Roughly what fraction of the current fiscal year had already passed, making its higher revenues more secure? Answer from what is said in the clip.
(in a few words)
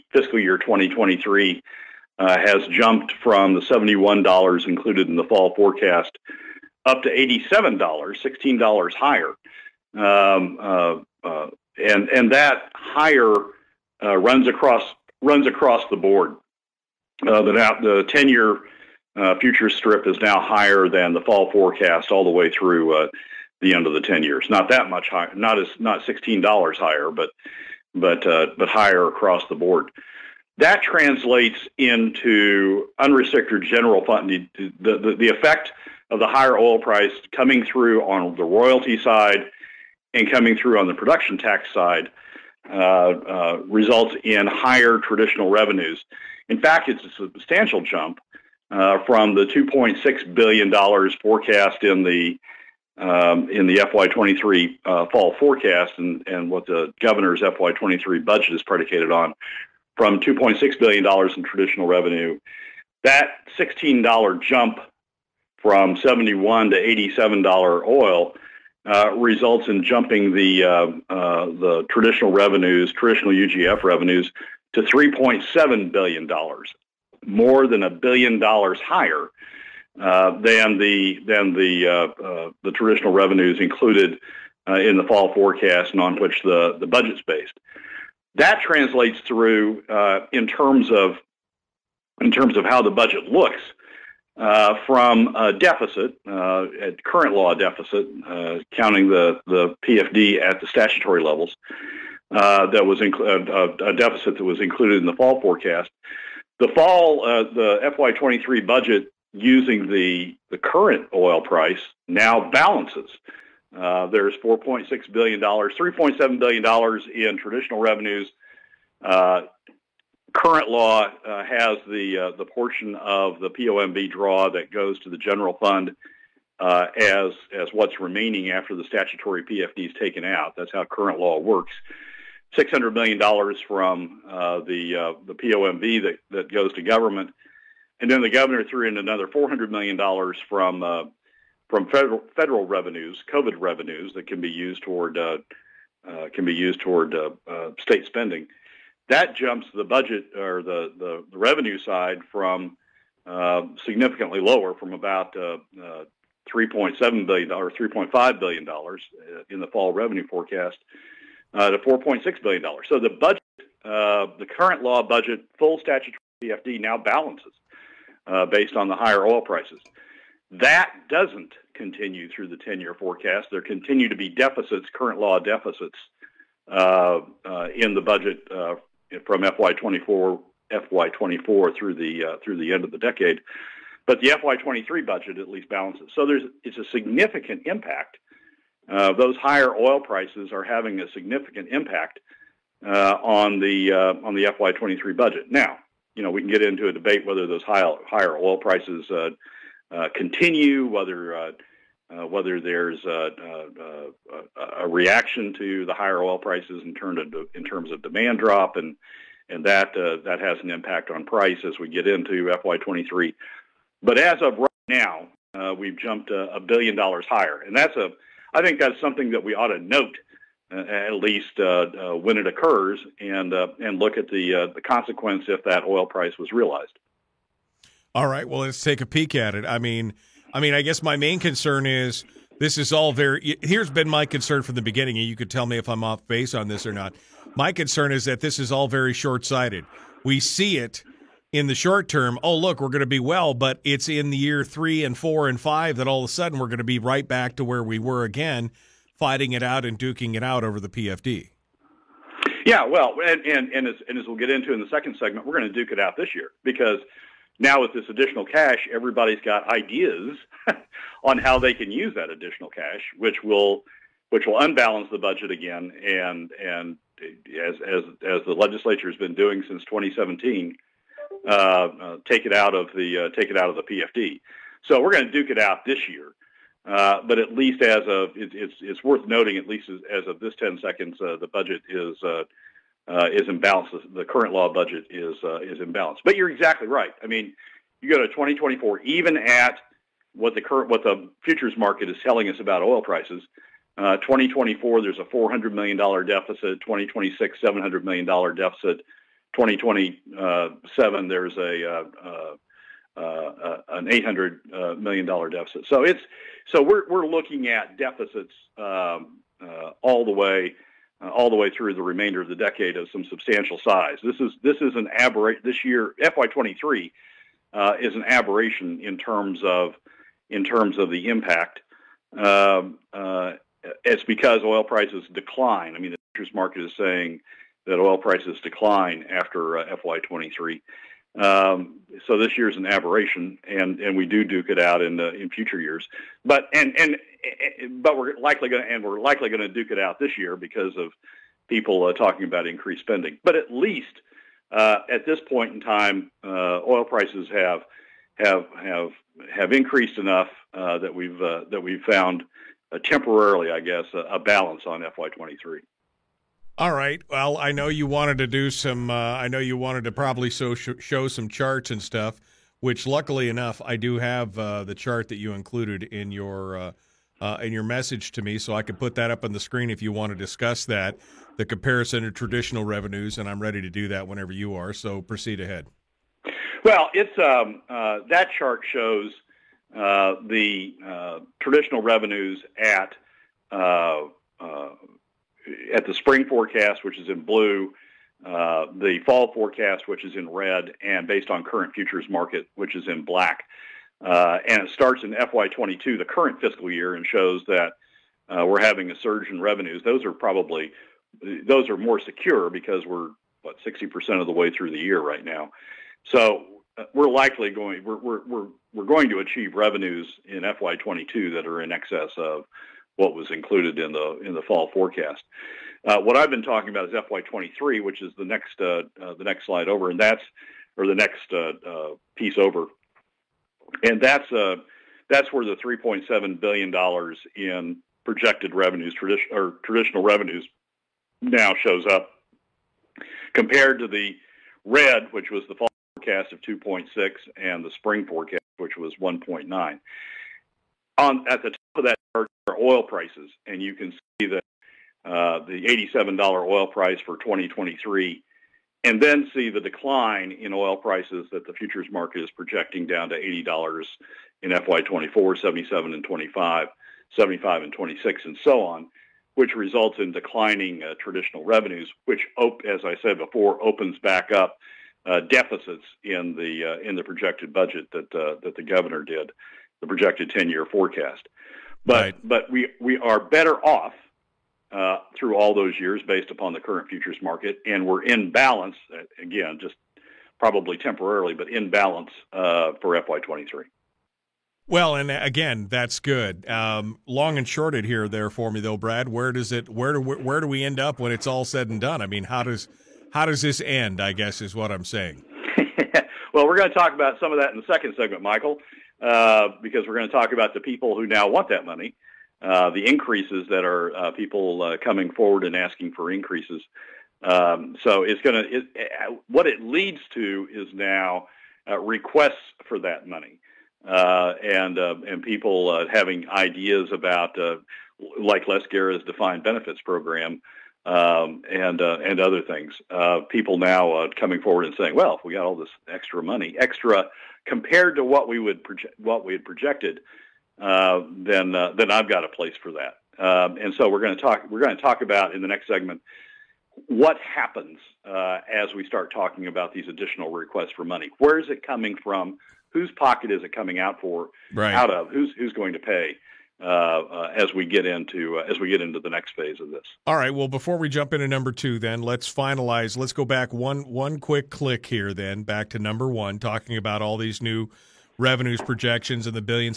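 60%.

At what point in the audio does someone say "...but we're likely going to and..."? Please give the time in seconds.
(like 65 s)
338 s.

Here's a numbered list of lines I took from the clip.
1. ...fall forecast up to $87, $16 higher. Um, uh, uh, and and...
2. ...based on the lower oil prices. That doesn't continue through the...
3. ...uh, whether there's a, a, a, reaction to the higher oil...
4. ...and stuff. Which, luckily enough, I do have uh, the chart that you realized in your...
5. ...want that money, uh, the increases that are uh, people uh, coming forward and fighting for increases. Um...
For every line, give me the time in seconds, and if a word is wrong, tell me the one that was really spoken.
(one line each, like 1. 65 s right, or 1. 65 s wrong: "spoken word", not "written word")
1. 5 s right
2. 168 s wrong: "higher", not "lower"
3. 201 s right
4. 361 s wrong: "included", not "realized"
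5. 501 s wrong: "asking", not "fighting".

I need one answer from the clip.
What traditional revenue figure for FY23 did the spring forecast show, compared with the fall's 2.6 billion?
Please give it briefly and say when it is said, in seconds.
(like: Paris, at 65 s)
1.9 billion, at 439 s.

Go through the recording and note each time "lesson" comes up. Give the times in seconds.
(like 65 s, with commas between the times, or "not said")
not said.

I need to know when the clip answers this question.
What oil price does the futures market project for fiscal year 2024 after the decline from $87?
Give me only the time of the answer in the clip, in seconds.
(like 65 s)
453 s.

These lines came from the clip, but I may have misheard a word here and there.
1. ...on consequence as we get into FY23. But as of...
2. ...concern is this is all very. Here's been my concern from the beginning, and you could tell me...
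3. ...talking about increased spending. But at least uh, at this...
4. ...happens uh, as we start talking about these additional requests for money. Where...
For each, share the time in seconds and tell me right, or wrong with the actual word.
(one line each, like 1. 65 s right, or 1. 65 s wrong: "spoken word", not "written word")
1. 211 s wrong: "price", not "consequence"
2. 231 s right
3. 342 s right
4. 537 s right.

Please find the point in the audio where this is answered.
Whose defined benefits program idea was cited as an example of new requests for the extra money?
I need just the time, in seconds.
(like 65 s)
518 s.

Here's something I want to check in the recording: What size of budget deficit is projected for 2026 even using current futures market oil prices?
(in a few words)
$700 million.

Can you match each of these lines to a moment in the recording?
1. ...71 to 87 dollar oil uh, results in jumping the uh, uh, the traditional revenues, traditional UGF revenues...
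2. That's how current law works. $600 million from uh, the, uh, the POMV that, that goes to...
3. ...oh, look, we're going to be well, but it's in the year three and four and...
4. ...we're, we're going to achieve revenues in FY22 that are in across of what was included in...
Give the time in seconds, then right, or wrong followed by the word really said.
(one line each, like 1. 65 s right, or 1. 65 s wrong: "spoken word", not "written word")
1. 65 s right
2. 130 s right
3. 242 s right
4. 408 s wrong: "excess", not "across".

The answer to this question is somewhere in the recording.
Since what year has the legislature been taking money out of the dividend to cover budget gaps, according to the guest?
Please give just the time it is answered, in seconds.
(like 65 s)
269 s.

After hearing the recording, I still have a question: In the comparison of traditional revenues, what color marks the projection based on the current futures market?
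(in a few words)
Black.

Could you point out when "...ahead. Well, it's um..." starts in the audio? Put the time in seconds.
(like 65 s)
375 s.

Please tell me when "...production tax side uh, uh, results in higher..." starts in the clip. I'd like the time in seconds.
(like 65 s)
40 s.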